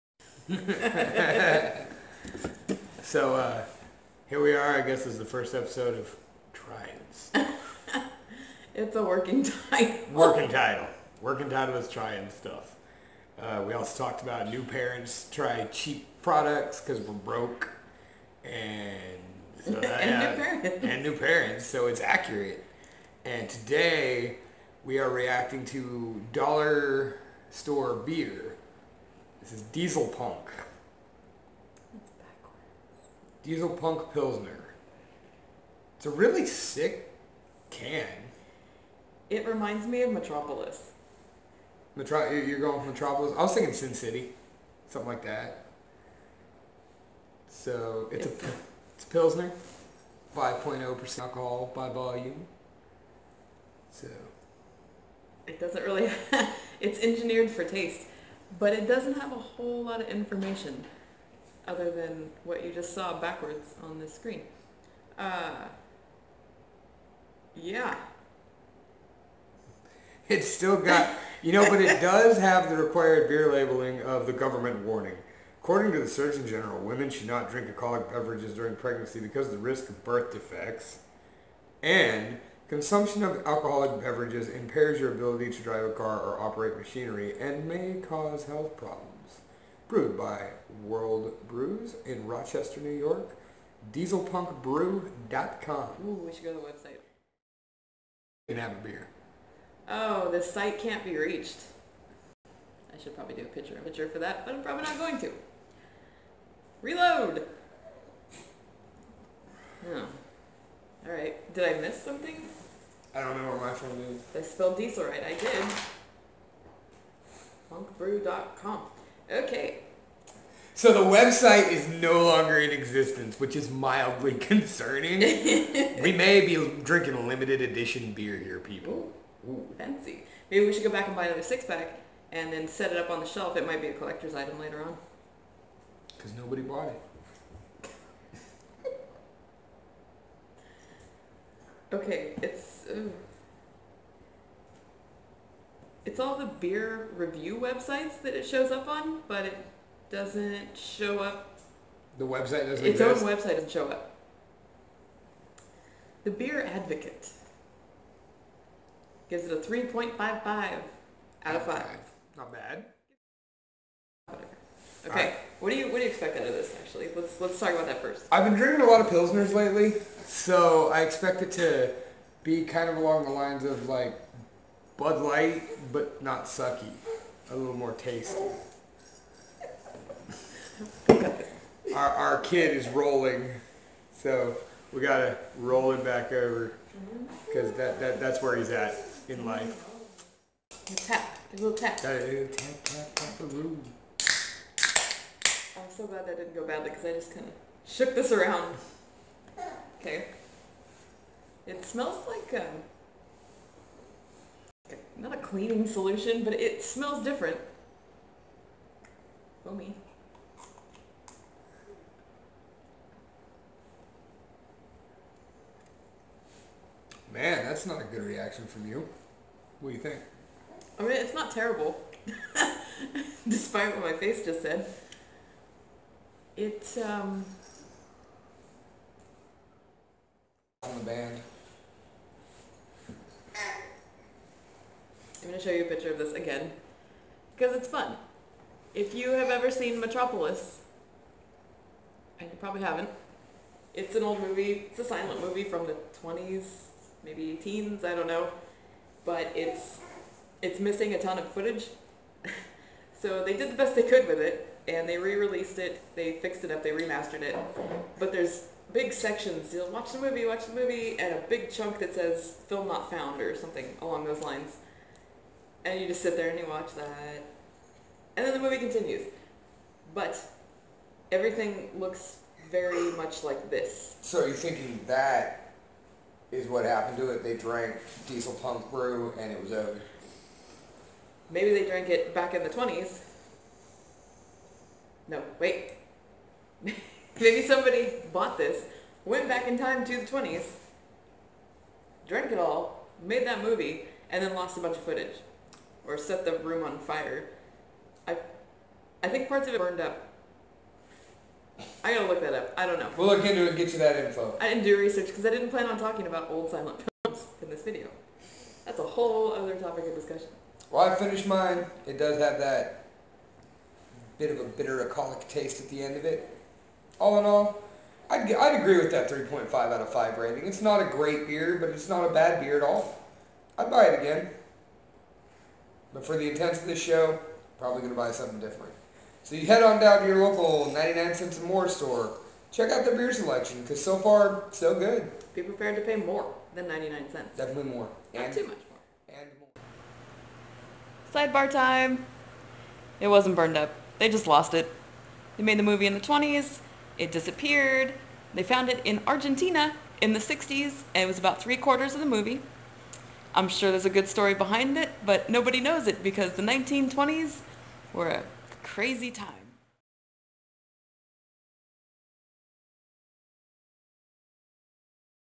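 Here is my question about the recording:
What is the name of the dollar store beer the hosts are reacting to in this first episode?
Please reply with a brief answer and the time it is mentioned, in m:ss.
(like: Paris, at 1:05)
Diesel Punk Pilsner, at 0:33.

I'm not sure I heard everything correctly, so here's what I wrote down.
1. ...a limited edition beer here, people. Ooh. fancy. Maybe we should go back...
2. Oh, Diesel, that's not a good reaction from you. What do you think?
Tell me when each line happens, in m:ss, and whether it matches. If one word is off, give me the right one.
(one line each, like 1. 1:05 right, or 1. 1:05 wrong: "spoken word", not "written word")
1. 2:07 right
2. 3:29 wrong: "Man", not "Diesel".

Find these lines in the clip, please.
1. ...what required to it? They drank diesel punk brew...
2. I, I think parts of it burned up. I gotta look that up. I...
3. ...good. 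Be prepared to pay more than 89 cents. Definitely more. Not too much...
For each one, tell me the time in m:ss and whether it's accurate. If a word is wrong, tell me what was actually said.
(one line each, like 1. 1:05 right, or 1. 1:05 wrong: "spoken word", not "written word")
1. 4:36 wrong: "happened", not "required"
2. 4:58 right
3. 5:34 wrong: "99", not "89".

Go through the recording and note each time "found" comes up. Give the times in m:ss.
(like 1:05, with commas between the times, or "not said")
4:23, 5:48.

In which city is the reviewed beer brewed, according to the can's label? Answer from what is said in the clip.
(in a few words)
Rochester.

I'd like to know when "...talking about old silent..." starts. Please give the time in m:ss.
5:05.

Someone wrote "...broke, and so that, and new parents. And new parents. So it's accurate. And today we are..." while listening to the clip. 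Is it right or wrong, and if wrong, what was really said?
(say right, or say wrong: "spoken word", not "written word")
right.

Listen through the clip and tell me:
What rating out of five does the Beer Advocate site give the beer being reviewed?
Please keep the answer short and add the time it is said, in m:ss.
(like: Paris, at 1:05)
3.55, at 2:39.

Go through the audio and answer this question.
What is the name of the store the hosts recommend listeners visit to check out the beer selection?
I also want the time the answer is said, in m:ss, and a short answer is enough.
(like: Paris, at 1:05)
99 cents and more, at 5:30.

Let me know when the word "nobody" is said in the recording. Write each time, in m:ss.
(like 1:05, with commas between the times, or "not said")
2:16, 5:55.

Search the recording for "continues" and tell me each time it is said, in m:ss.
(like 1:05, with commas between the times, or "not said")
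4:28.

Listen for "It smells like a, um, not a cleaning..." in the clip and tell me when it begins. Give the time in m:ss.
3:21.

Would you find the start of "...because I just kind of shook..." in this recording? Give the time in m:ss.
3:16.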